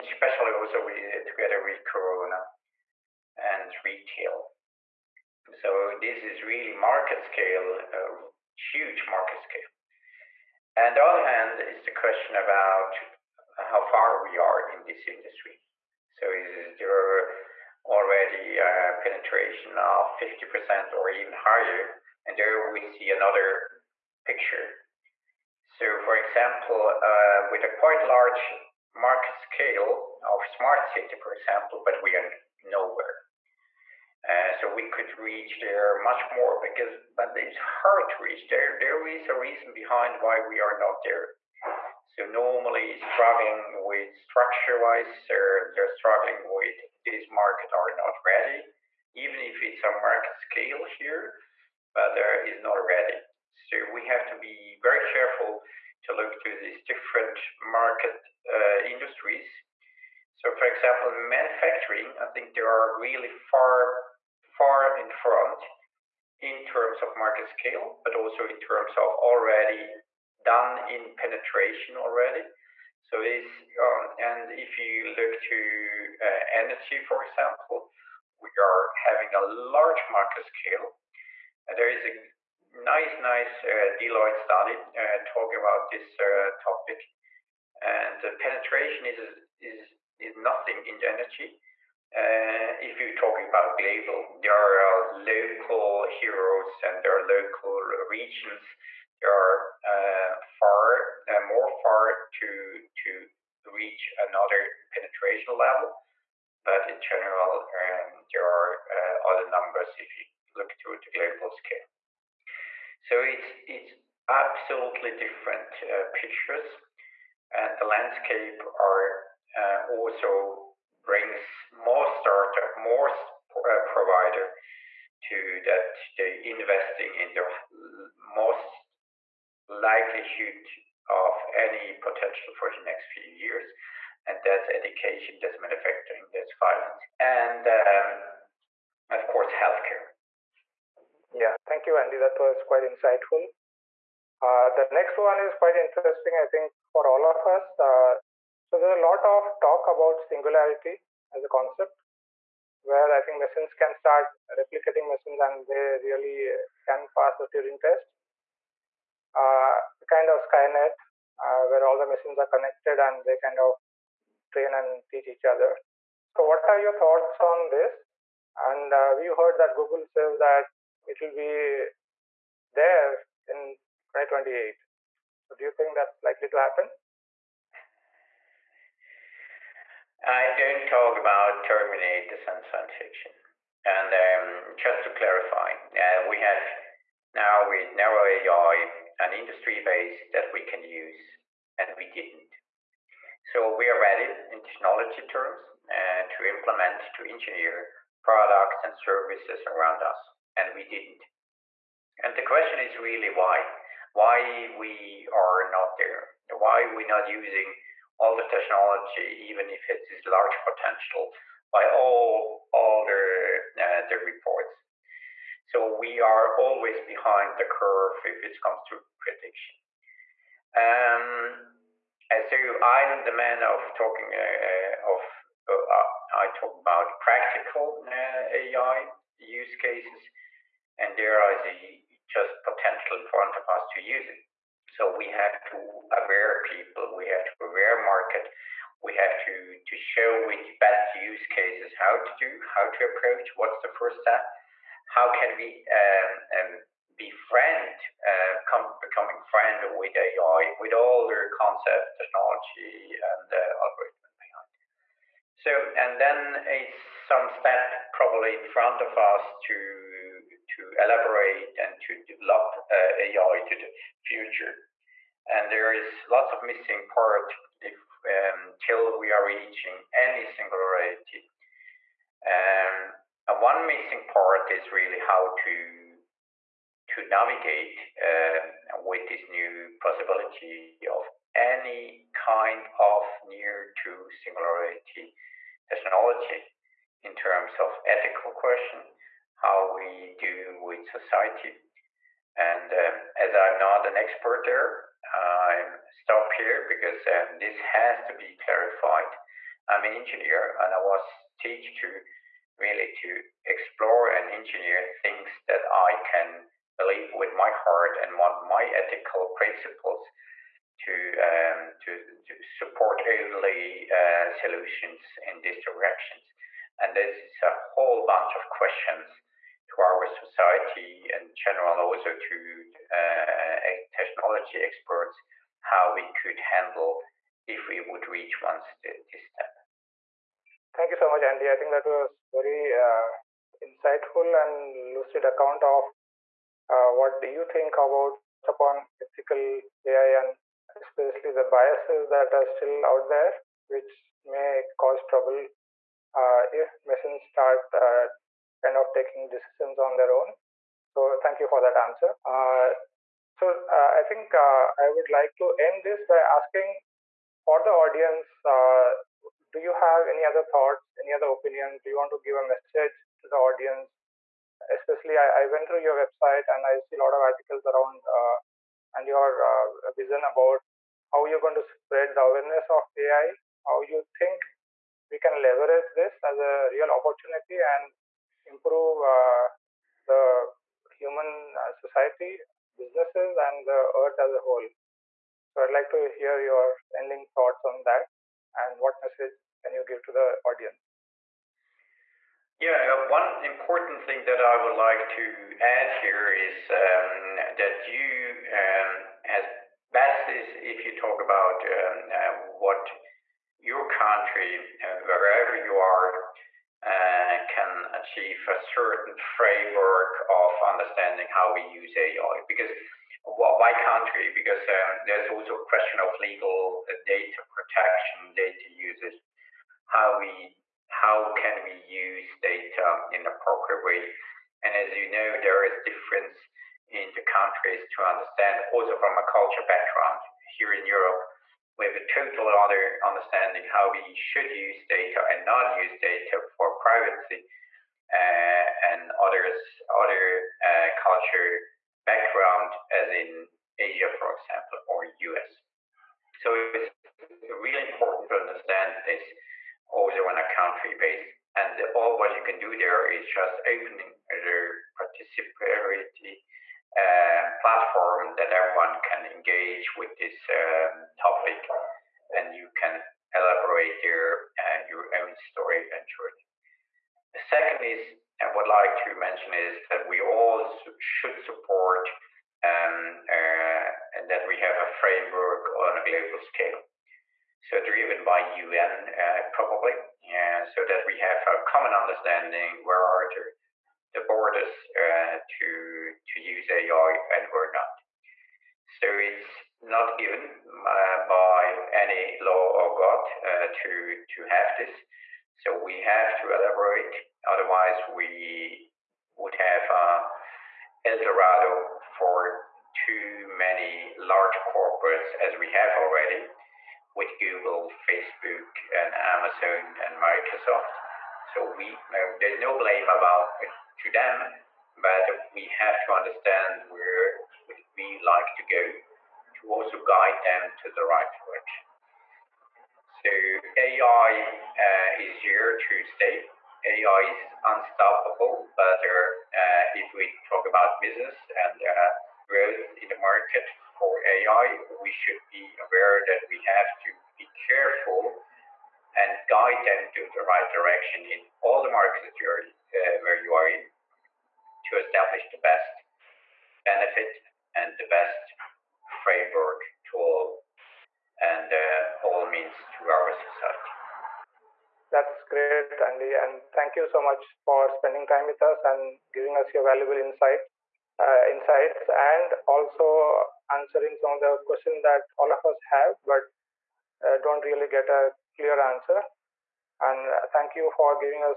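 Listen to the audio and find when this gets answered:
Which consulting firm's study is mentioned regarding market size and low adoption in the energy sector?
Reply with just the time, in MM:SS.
01:23.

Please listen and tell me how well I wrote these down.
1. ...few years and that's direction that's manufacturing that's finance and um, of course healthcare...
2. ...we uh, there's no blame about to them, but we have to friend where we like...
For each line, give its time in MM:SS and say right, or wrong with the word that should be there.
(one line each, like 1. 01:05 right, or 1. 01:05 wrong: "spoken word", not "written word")
1. 02:13 wrong: "education", not "direction"
2. 08:31 wrong: "understand", not "friend".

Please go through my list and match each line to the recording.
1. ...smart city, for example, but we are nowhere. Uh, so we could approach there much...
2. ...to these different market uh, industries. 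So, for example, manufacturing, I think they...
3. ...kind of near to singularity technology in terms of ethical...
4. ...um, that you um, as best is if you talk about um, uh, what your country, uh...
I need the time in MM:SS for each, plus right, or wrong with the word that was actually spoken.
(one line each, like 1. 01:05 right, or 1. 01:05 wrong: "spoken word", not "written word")
1. 00:30 wrong: "reach", not "approach"
2. 00:56 right
3. 04:42 right
4. 06:36 right.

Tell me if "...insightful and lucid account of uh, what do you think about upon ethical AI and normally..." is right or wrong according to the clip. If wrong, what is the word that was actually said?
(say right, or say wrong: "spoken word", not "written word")
wrong: "especially", not "normally".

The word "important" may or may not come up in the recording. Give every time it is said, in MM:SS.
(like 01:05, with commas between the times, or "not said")
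06:33, 07:28.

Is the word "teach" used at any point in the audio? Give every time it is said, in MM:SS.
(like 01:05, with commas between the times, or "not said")
02:45, 05:01.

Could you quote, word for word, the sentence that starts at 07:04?
And as you know, there is difference in the countries to understand, also from a culture background.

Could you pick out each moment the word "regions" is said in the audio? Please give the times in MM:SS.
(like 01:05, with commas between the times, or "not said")
01:37.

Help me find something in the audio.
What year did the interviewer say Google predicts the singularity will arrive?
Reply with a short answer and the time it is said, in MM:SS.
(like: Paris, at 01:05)
2028, at 02:54.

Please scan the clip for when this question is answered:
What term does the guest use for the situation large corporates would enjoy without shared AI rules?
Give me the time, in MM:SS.
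08:21.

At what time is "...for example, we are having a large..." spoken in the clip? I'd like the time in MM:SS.
01:17.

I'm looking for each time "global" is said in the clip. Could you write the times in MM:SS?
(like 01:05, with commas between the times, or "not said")
01:33, 01:51, 07:56.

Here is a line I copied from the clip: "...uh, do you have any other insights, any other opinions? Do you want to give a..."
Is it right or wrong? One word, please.
wrong.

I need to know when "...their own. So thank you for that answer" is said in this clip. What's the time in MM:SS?
05:50.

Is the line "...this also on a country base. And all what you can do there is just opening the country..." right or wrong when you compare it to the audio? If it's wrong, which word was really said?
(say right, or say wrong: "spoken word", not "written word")
wrong: "participatory", not "country".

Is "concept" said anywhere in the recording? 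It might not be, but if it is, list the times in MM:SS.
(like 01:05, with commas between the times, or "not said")
02:31, 04:11.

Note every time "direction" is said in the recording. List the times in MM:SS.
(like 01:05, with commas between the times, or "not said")
05:15, 08:41, 09:00.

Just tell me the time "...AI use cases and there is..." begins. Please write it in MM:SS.
03:48.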